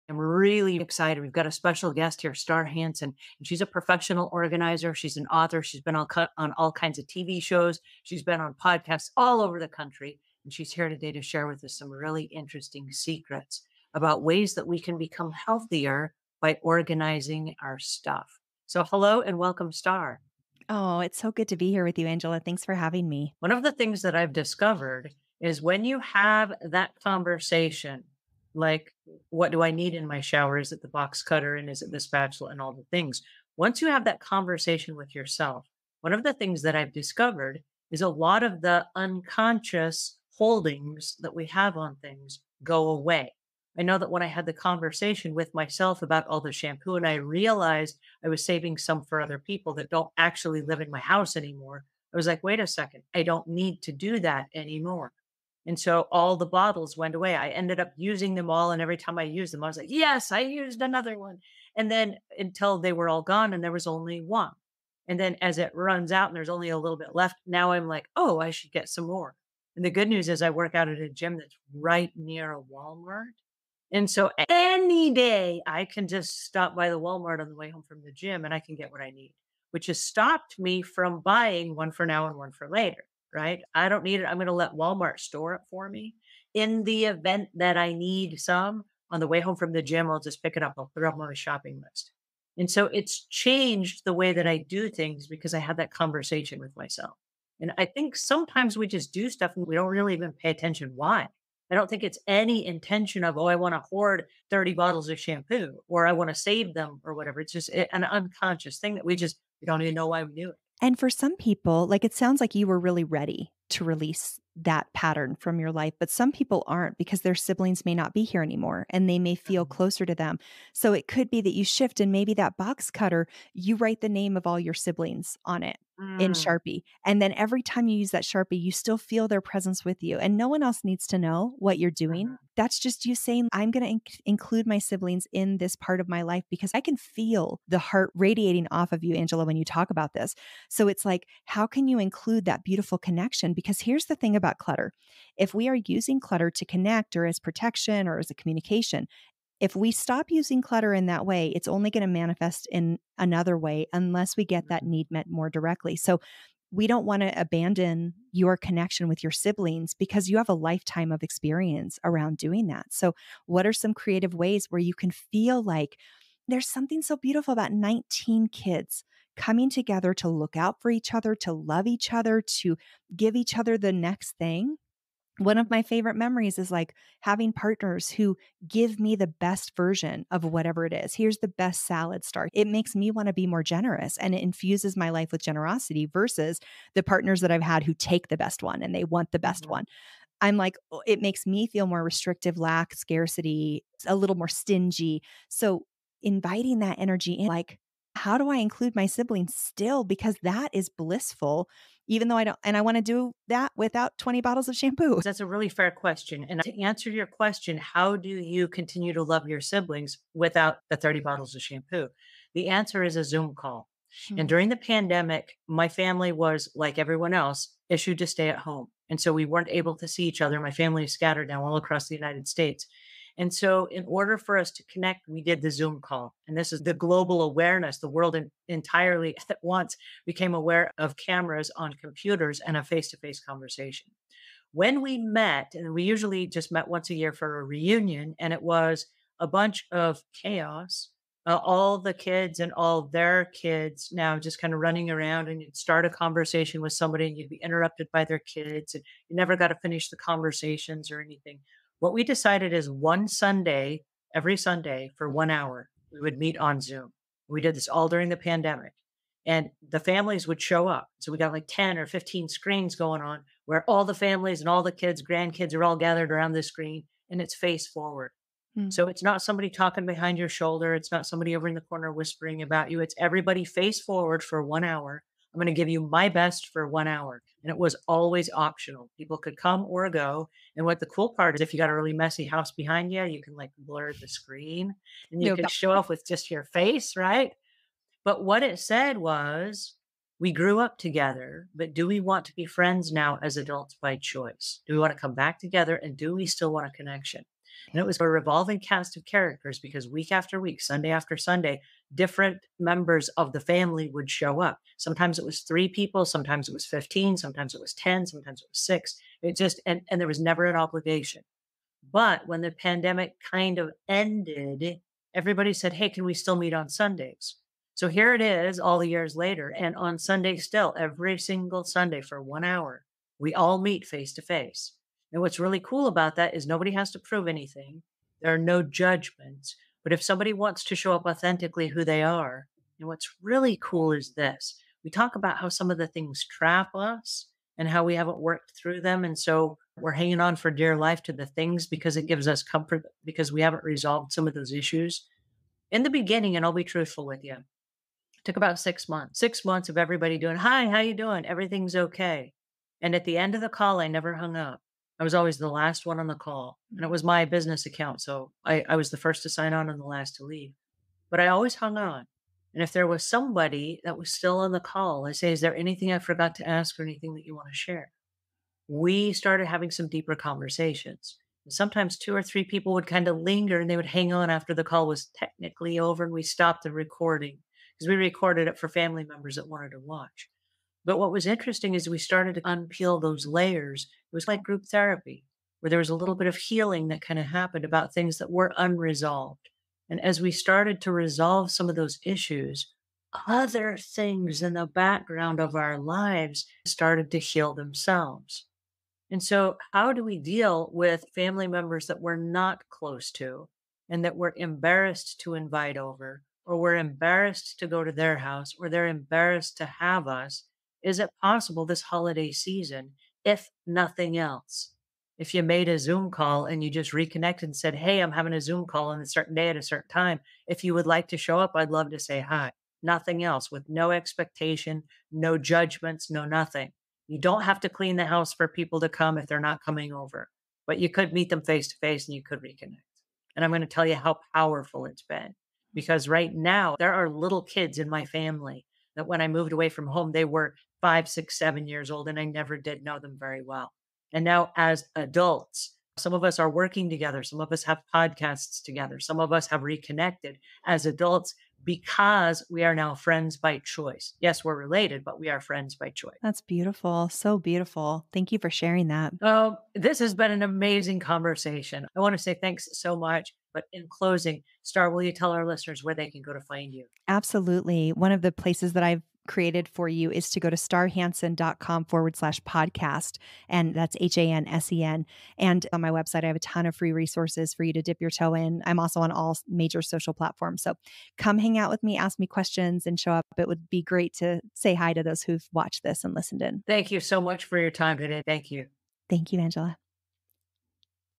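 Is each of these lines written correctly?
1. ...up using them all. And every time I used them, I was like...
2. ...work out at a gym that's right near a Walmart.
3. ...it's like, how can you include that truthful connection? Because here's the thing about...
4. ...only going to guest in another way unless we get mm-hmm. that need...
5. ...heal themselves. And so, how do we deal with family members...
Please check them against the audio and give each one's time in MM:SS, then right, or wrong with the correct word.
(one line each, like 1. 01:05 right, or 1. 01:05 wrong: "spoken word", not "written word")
1. 00:57 right
2. 01:10 right
3. 02:20 wrong: "beautiful", not "truthful"
4. 02:31 wrong: "manifest", not "guest"
5. 06:37 right.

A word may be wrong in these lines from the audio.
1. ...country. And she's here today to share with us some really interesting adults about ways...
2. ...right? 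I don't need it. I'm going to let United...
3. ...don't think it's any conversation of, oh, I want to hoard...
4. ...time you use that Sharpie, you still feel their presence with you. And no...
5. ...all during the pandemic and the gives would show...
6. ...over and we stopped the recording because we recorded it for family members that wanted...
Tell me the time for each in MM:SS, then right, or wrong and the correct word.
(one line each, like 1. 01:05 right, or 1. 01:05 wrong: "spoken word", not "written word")
1. 00:09 wrong: "secrets", not "adults"
2. 01:23 wrong: "Walmart", not "United"
3. 01:41 wrong: "intention", not "conversation"
4. 02:07 right
5. 04:17 wrong: "families", not "gives"
6. 06:15 right.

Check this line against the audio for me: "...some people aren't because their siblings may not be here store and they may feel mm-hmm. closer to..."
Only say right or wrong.
wrong.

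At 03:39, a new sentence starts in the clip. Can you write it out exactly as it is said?
And so we weren't able to see each other.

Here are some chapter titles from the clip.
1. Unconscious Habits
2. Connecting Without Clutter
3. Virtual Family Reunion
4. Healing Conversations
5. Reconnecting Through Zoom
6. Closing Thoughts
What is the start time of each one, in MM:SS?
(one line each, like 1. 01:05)
1. 01:46
2. 03:19
3. 04:39
4. 05:45
5. 06:50
6. 07:37.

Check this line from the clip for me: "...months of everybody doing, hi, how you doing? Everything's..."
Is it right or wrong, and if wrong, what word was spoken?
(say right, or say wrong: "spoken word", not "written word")
right.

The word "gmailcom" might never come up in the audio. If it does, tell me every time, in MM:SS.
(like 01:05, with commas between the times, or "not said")
not said.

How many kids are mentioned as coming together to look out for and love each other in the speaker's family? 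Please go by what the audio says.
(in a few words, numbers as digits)
19.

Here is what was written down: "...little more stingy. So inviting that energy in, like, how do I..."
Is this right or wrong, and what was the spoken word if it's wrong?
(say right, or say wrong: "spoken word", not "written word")
right.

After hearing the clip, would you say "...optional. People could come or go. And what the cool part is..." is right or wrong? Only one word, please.
right.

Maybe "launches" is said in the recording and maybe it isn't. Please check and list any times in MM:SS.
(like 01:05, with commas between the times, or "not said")
not said.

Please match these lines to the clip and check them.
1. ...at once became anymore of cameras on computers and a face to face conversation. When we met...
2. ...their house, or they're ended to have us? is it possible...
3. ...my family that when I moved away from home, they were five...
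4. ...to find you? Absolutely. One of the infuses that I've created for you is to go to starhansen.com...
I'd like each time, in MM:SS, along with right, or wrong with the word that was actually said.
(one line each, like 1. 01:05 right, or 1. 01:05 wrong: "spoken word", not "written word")
1. 03:49 wrong: "aware", not "anymore"
2. 06:48 wrong: "embarrassed", not "ended"
3. 07:18 right
4. 07:46 wrong: "places", not "infuses".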